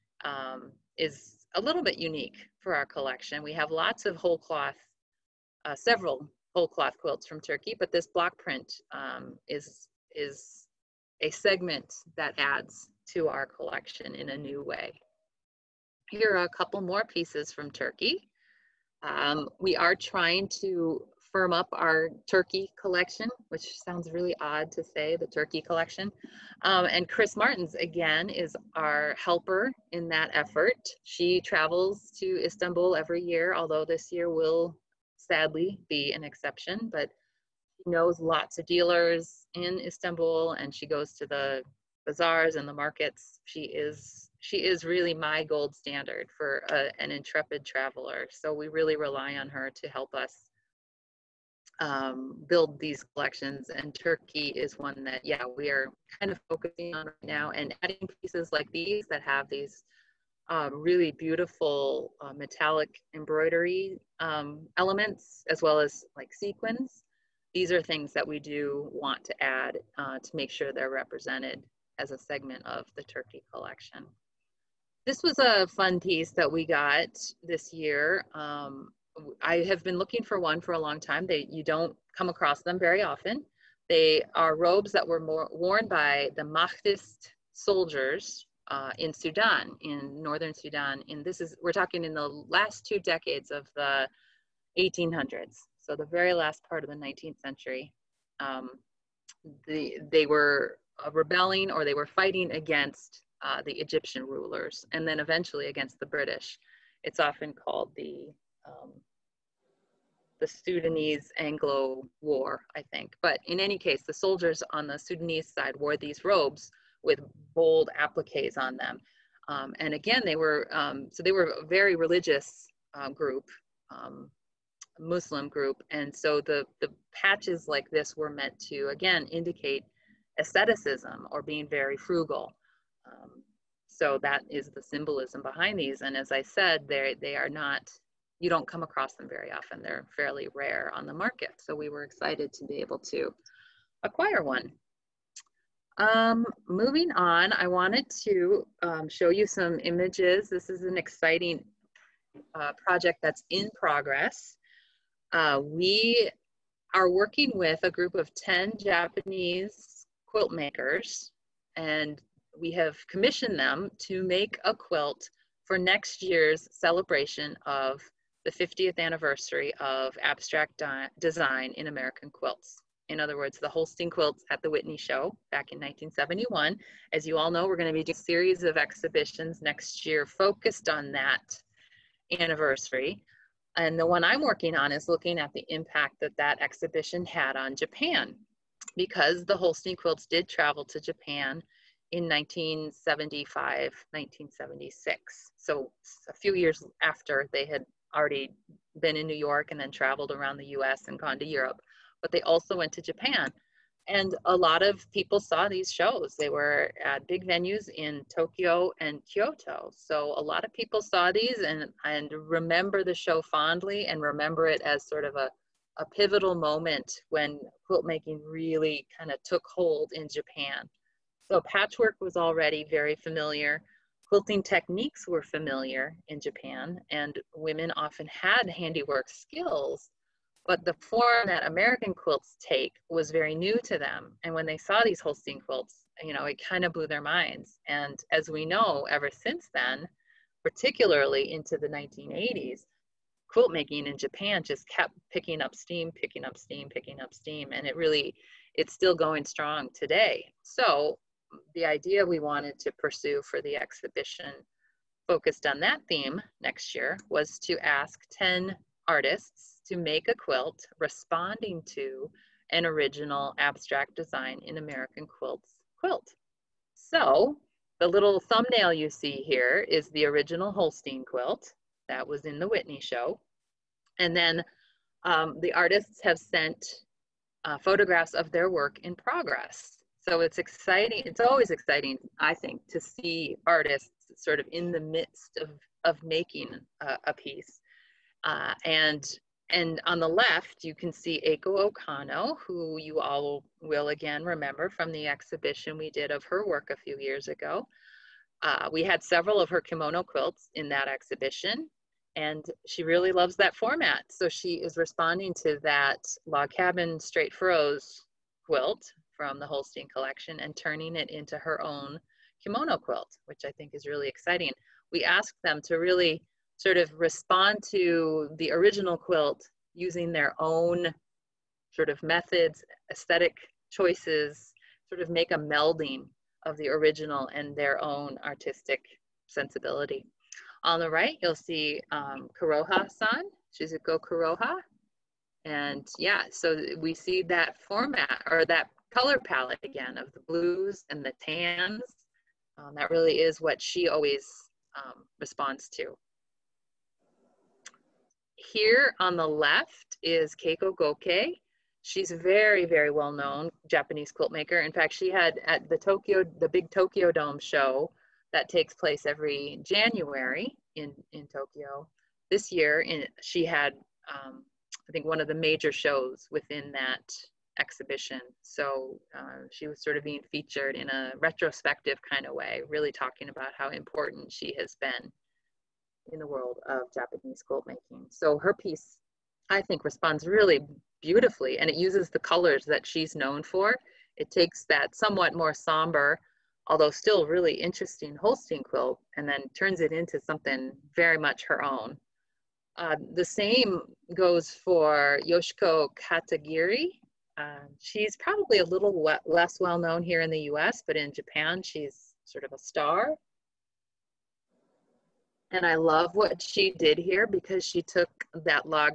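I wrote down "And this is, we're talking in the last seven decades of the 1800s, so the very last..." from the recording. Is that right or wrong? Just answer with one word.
wrong.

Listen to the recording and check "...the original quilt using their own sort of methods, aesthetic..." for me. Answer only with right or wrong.
right.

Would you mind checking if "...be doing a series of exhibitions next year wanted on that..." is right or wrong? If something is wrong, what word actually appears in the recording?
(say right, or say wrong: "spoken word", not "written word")
wrong: "focused", not "wanted".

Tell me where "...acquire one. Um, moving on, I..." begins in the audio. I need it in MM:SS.
02:24.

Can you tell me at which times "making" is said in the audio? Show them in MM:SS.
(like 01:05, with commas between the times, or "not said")
03:38, 04:03, 04:46, 06:17.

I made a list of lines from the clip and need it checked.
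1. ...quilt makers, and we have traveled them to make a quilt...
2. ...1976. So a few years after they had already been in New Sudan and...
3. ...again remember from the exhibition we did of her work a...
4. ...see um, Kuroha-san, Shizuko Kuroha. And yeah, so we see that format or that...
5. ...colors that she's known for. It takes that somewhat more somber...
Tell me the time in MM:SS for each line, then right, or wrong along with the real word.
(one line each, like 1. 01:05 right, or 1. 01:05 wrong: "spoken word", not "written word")
1. 02:40 wrong: "commissioned", not "traveled"
2. 03:14 wrong: "York", not "Sudan"
3. 04:54 right
4. 05:31 right
5. 06:22 right.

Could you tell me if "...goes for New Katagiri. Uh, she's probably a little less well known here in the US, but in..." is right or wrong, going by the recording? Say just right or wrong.
wrong.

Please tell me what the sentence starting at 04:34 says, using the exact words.
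And then um, the artists have sent uh, photographs of their work in progress.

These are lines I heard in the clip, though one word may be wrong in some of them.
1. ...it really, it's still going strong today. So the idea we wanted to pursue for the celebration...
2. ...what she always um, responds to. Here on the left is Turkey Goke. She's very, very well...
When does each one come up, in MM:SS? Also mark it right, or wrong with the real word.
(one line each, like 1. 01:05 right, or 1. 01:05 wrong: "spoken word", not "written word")
1. 04:07 wrong: "exhibition", not "celebration"
2. 05:43 wrong: "Keiko", not "Turkey".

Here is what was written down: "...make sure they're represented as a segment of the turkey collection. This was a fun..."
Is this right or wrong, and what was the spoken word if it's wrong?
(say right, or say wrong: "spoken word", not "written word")
right.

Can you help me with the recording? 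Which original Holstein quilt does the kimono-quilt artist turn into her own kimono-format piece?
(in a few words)
log cabin straight furrows.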